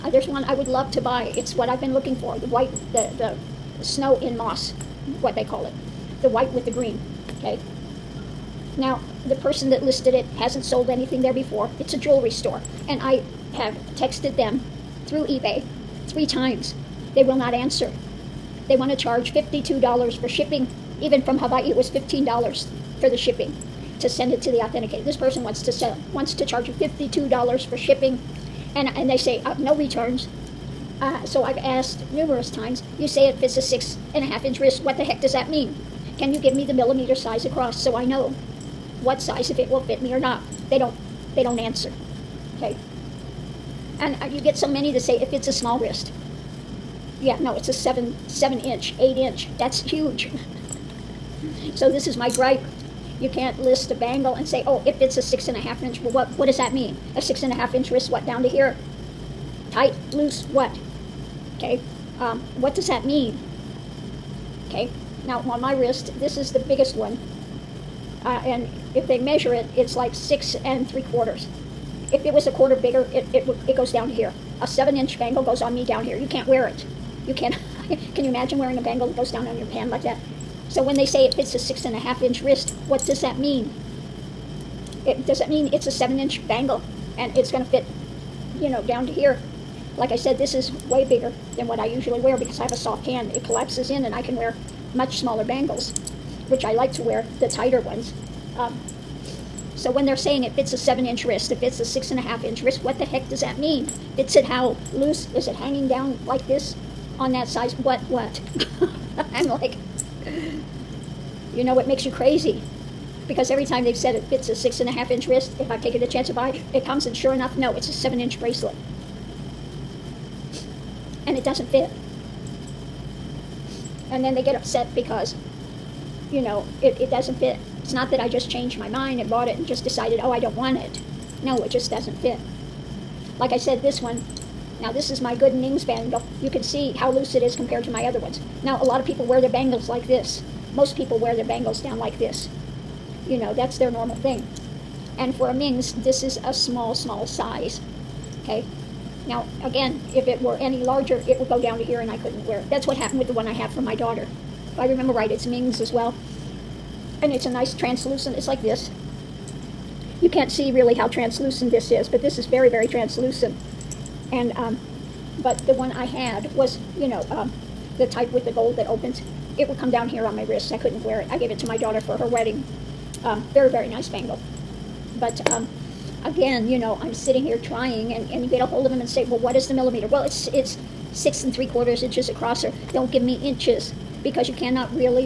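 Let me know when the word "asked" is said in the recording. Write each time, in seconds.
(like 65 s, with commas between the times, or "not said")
31 s.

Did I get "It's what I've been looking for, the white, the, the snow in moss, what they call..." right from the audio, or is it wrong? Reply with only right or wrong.
right.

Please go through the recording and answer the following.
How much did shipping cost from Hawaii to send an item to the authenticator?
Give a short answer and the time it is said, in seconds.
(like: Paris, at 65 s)
$15, at 21 s.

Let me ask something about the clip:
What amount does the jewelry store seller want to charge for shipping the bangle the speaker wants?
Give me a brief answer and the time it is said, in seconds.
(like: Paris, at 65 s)
$52, at 19 s.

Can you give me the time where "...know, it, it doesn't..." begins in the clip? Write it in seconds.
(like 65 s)
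126 s.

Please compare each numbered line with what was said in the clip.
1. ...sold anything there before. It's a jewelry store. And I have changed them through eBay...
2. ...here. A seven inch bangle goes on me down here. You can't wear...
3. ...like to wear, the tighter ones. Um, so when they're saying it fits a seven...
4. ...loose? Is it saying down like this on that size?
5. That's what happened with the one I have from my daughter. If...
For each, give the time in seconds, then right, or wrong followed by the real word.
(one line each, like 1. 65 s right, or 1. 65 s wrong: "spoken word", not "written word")
1. 10 s wrong: "texted", not "changed"
2. 74 s right
3. 96 s right
4. 104 s wrong: "hanging", not "saying"
5. 152 s right.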